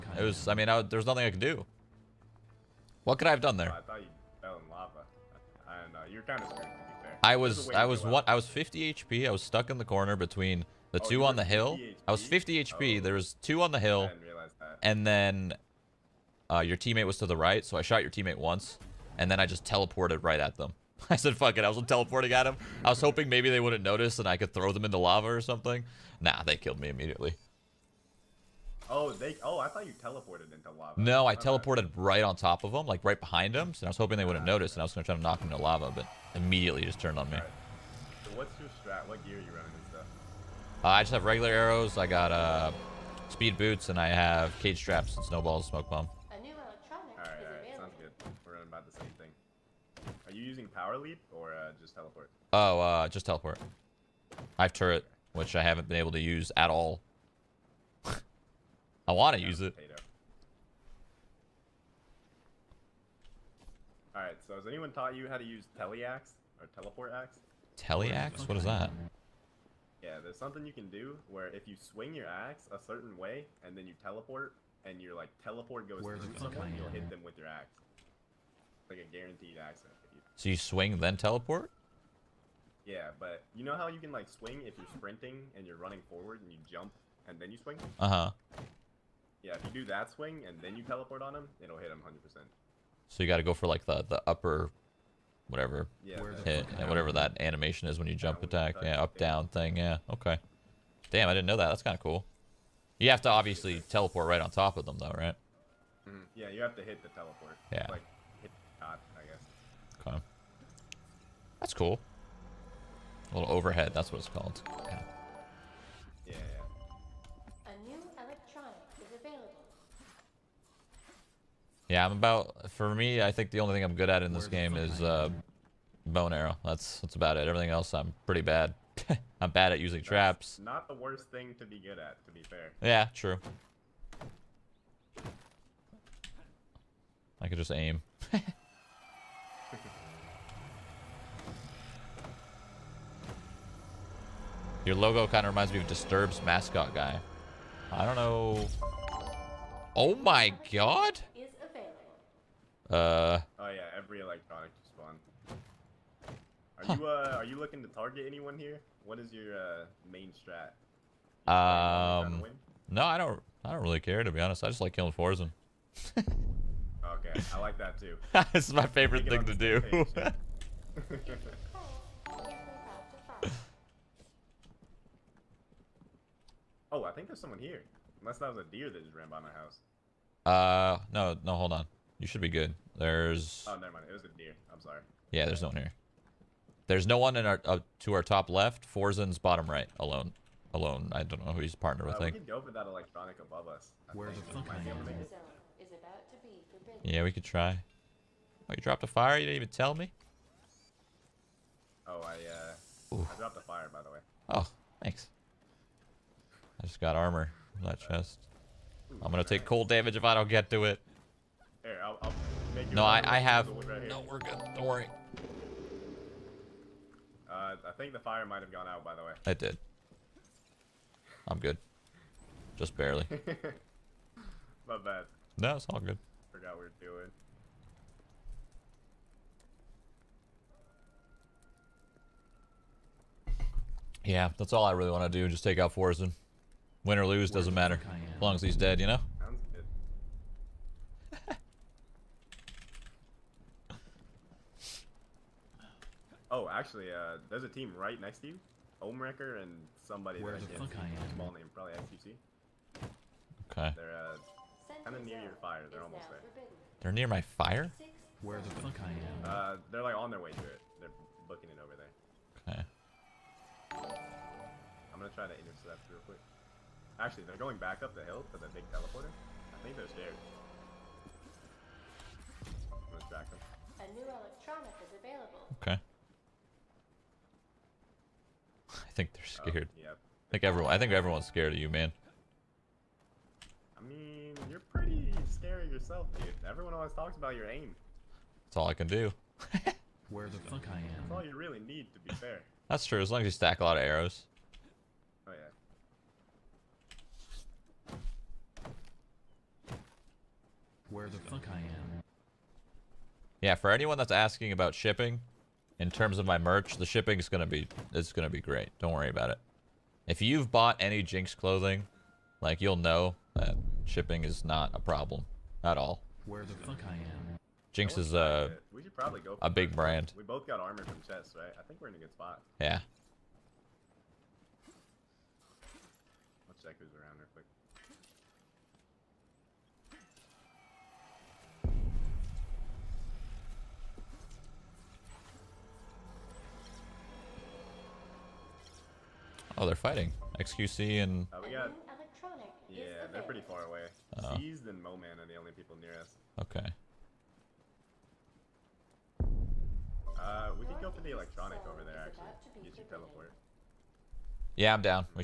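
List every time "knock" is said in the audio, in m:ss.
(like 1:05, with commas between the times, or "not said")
0:35.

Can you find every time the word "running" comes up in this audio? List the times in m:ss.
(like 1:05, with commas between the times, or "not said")
0:39, 1:25.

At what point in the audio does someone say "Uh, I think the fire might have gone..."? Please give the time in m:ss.
3:37.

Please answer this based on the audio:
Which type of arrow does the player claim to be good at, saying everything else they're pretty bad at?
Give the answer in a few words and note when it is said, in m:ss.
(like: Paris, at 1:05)
Bone arrow, at 2:06.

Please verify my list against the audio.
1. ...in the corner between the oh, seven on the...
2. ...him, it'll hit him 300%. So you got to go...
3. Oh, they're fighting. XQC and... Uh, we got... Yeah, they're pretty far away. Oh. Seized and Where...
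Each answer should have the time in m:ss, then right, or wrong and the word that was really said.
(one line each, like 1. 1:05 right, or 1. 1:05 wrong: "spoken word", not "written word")
1. 0:09 wrong: "two", not "seven"
2. 1:31 wrong: "100", not "300"
3. 5:39 wrong: "Moman", not "Where".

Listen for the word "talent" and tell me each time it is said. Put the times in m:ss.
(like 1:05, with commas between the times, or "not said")
not said.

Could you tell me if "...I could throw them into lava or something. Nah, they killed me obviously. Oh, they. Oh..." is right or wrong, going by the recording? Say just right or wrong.
wrong.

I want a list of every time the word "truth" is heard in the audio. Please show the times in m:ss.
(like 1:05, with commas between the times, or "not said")
not said.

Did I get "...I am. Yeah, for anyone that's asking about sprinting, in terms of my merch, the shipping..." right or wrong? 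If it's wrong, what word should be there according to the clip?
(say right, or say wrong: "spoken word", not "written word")
wrong: "shipping", not "sprinting".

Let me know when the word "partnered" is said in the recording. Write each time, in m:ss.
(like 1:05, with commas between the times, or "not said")
3:11.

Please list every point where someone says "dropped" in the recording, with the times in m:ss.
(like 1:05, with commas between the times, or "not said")
3:18, 3:23.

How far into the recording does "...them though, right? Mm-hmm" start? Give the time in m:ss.
1:44.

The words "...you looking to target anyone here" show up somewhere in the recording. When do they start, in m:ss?
2:37.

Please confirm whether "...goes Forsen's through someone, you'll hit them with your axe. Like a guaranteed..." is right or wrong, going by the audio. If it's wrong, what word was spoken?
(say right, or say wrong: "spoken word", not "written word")
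wrong: "Where", not "Forsen".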